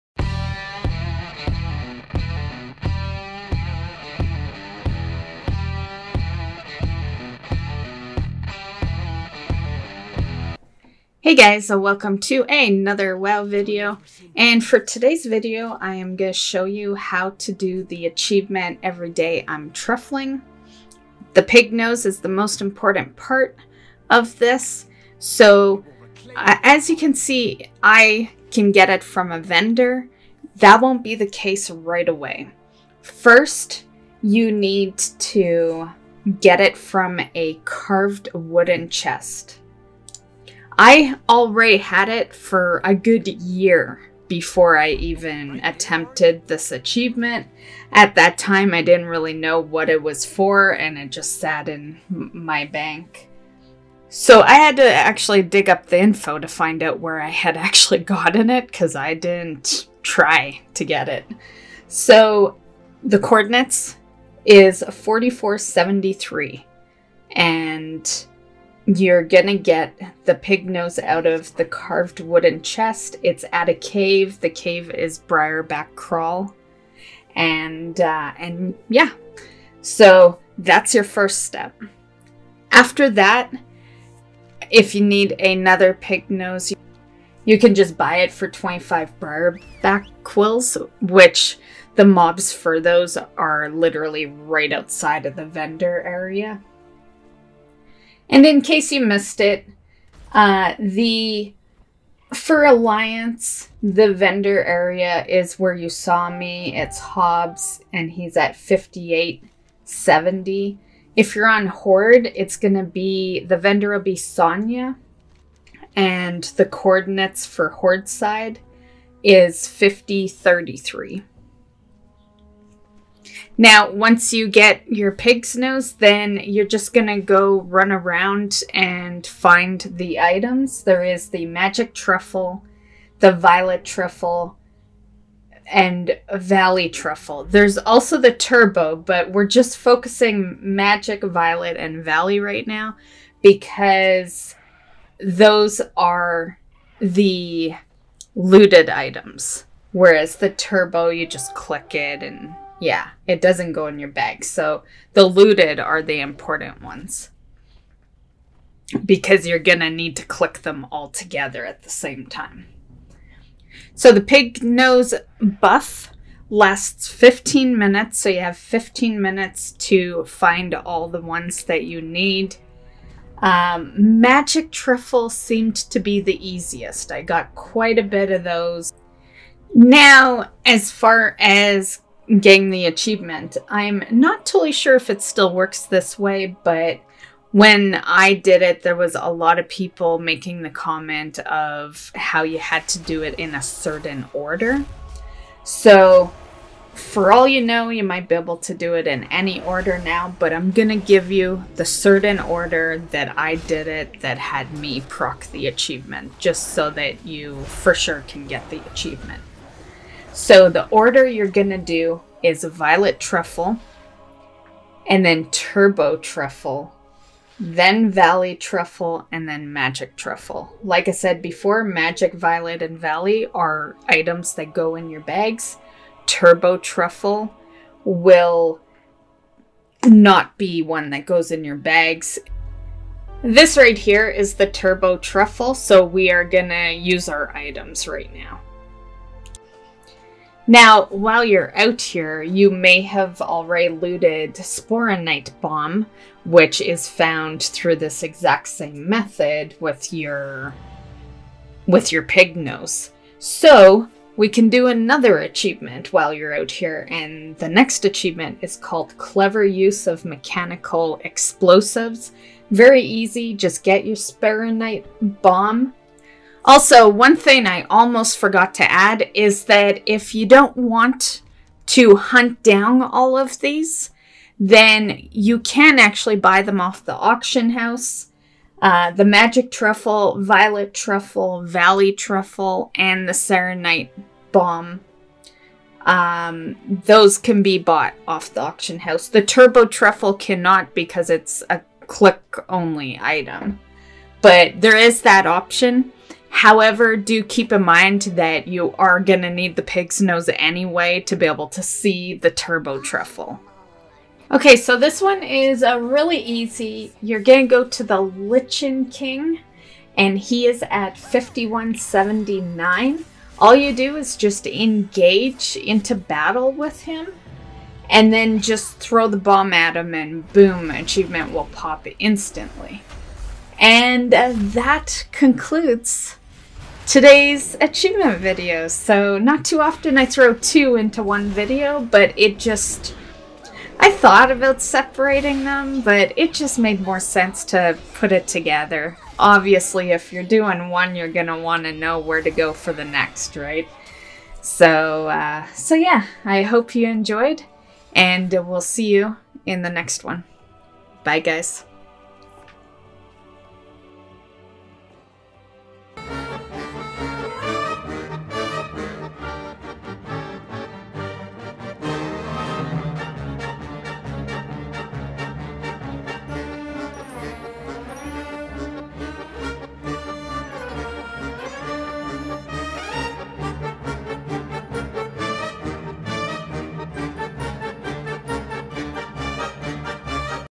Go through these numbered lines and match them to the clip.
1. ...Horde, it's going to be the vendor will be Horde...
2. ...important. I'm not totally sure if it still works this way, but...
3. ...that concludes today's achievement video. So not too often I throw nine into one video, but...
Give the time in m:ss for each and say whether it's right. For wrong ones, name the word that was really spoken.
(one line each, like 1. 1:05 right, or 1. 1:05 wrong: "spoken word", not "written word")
1. 1:51 wrong: "Sonya", not "Horde"
2. 3:02 wrong: "achievement", not "important"
3. 5:24 wrong: "two", not "nine".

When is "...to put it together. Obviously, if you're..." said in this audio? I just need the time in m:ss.
5:37.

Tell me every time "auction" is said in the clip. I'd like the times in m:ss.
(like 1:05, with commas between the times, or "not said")
4:37, 4:48.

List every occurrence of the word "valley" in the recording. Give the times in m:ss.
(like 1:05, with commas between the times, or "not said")
2:16, 2:22, 3:38, 3:42, 4:41.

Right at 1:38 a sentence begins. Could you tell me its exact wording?
And in case you missed it, uh, the for Alliance, the vendor area is where you saw me.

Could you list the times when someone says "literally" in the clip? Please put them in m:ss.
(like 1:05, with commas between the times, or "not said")
1:33.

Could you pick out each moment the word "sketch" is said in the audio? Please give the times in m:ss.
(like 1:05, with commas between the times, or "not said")
not said.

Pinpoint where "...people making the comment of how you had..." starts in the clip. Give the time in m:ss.
3:09.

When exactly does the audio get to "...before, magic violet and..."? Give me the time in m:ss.
3:41.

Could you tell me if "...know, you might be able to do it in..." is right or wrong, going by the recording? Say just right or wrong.
right.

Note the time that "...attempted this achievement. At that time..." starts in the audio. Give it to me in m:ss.
0:45.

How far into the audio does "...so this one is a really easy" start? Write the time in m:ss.
5:04.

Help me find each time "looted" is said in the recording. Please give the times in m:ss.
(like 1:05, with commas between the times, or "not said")
2:28, 2:35, 4:03.